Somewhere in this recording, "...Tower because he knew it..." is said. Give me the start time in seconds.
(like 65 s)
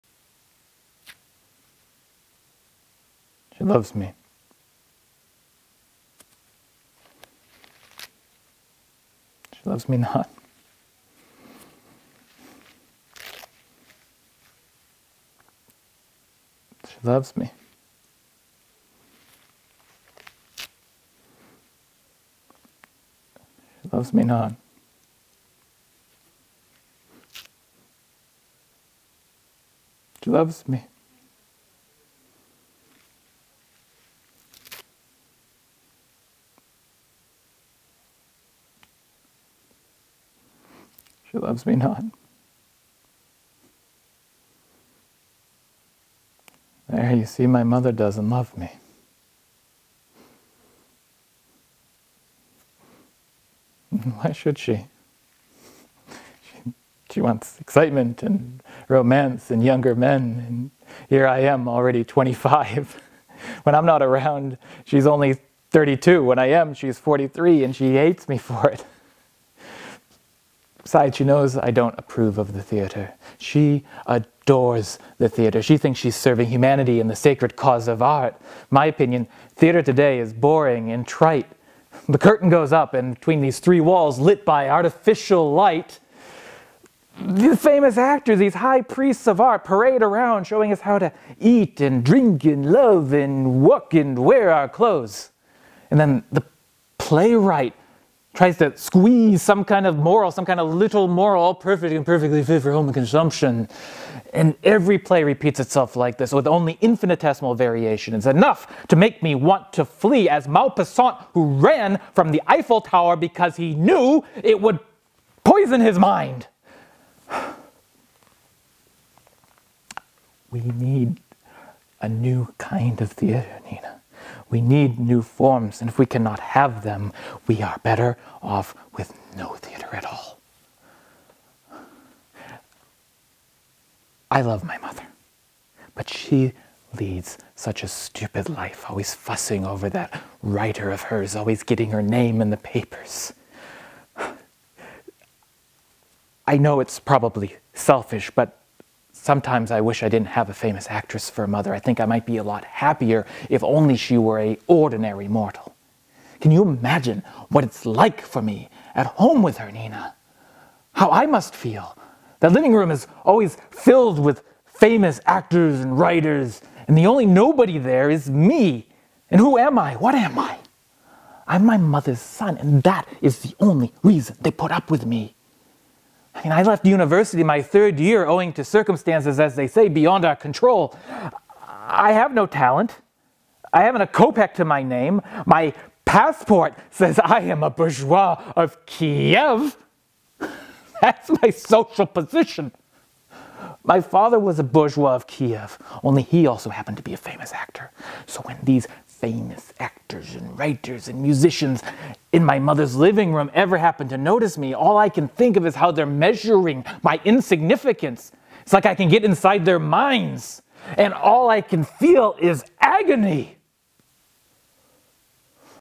112 s.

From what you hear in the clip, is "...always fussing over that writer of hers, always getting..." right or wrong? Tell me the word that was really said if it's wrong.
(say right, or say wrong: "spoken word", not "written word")
right.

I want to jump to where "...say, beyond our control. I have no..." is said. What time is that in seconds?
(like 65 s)
179 s.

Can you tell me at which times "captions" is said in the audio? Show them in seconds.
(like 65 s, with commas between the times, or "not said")
not said.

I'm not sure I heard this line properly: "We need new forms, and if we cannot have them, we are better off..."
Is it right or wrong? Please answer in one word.
right.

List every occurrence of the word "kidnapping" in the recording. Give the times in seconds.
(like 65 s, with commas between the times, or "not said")
not said.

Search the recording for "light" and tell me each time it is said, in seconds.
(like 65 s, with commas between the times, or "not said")
85 s.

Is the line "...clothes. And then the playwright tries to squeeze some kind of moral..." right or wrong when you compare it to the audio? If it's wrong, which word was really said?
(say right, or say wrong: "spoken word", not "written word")
right.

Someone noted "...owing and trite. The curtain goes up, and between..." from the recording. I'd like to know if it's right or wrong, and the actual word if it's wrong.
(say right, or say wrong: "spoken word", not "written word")
wrong: "boring", not "owing".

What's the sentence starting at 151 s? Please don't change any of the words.
I think I might be a lot happier if only she were a ordinary mortal.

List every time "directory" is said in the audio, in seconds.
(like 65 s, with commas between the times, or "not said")
not said.